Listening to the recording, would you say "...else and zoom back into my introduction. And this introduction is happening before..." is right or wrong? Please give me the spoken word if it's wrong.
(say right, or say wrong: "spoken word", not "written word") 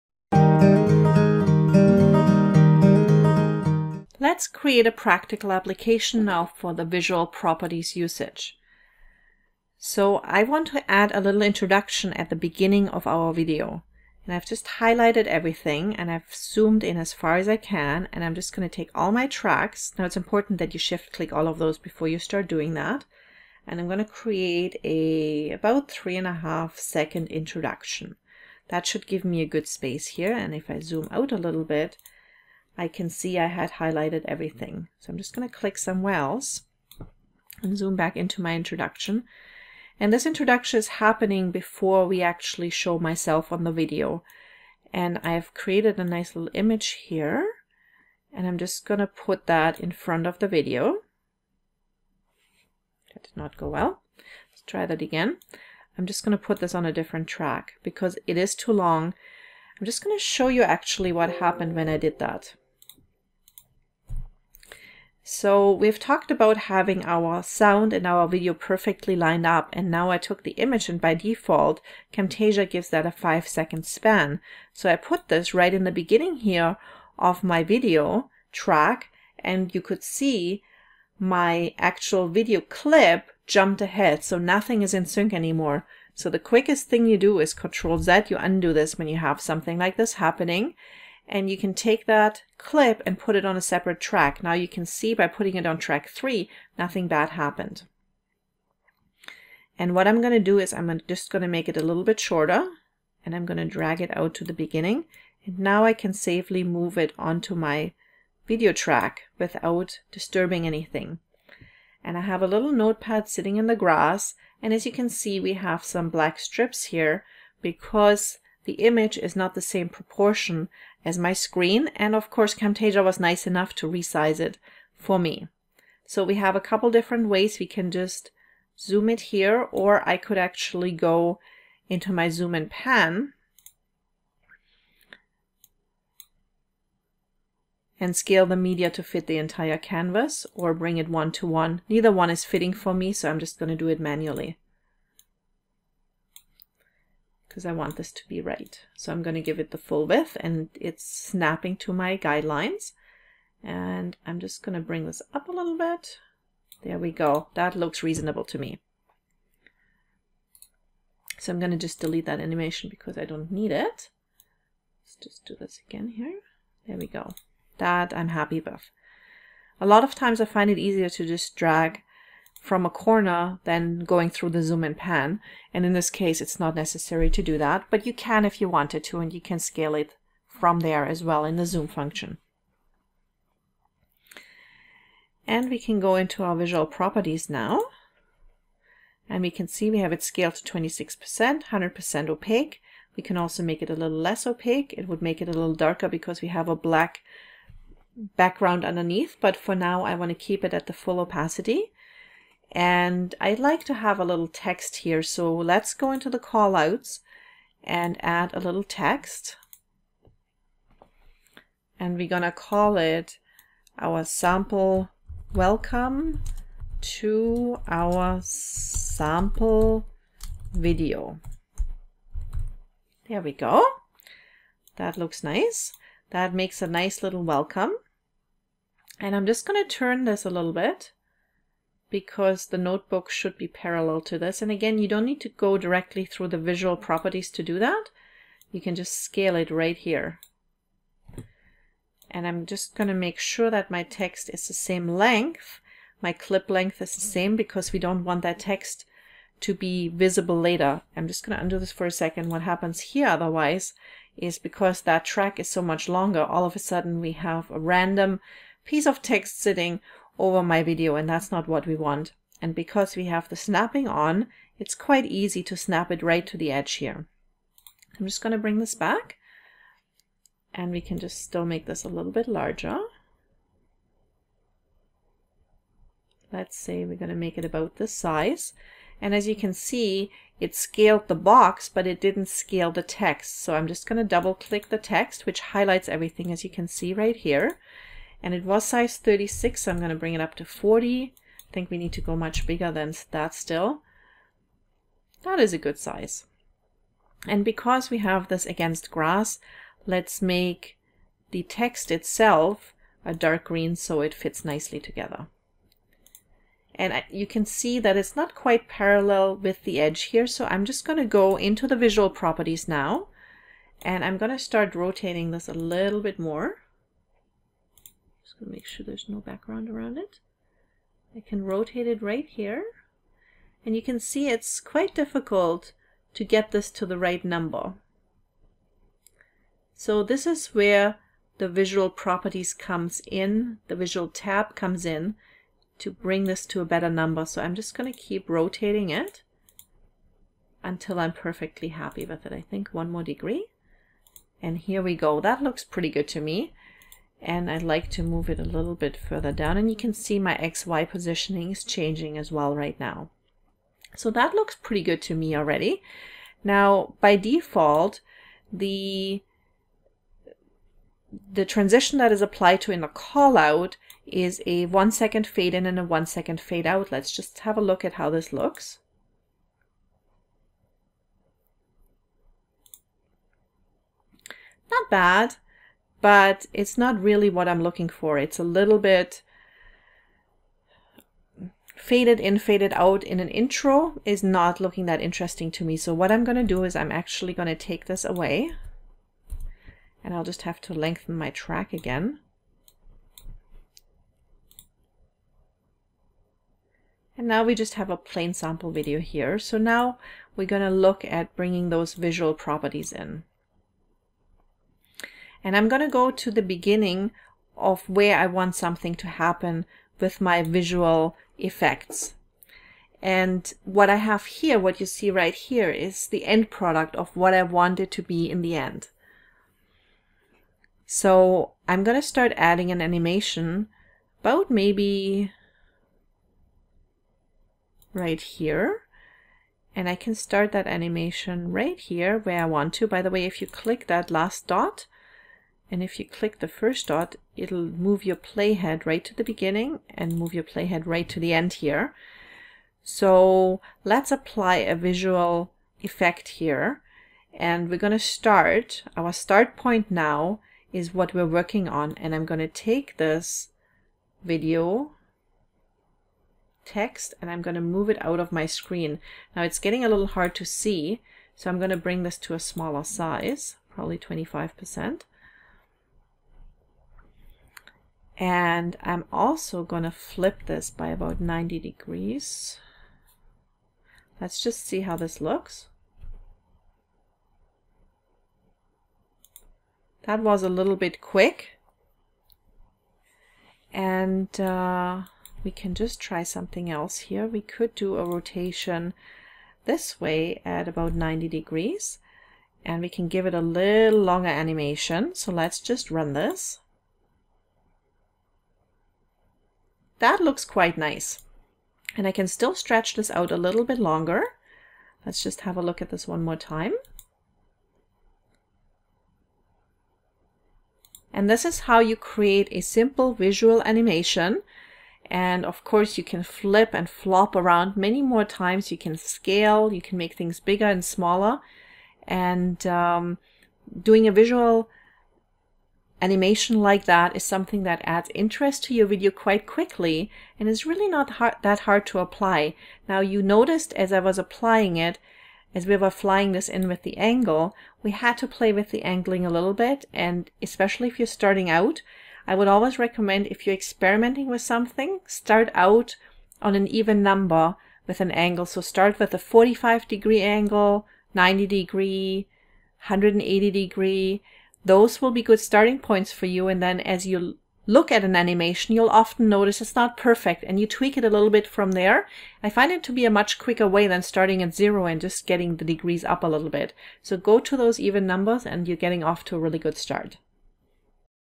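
right.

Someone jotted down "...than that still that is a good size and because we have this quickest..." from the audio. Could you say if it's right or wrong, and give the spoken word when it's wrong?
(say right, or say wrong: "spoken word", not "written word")
wrong: "against", not "quickest".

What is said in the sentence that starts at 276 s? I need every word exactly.
Let's say we're going to make it about this size.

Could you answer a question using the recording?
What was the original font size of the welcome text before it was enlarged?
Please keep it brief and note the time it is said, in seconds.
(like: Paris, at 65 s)
36, at 289 s.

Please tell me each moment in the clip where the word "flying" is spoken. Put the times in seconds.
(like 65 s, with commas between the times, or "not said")
536 s.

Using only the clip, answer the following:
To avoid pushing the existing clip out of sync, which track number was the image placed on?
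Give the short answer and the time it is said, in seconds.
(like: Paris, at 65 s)
Track 3, at 95 s.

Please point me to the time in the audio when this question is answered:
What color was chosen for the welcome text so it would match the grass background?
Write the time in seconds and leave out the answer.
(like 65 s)
303 s.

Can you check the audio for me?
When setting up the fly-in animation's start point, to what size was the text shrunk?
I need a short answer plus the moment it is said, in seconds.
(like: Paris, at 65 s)
25%, at 464 s.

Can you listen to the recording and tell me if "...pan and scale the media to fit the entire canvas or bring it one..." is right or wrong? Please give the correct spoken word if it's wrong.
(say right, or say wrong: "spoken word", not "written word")
right.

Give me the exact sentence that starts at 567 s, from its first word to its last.
So go to those even numbers and you're getting off to a really good start.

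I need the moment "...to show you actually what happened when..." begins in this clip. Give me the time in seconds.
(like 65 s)
60 s.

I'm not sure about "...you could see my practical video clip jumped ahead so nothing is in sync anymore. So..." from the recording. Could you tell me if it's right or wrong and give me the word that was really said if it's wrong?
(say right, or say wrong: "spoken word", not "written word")
wrong: "actual", not "practical".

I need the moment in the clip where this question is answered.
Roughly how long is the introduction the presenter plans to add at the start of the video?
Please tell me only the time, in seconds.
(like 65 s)
25 s.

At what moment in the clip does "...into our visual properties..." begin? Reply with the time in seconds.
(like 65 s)
186 s.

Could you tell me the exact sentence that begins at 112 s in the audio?
And I have a little notepad sitting in the grass.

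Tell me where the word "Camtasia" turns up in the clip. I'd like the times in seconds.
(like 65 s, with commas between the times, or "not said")
72 s, 122 s.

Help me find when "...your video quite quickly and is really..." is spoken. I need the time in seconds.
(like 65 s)
528 s.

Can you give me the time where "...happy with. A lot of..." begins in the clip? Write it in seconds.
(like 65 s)
168 s.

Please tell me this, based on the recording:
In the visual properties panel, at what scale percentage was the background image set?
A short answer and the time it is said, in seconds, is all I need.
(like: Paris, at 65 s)
26%, at 190 s.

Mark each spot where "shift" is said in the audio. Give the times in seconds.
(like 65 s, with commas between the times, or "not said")
20 s.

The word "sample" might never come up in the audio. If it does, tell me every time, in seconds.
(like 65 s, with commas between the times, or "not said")
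214 s, 218 s, 398 s.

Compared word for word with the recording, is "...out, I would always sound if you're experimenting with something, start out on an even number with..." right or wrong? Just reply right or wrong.
wrong.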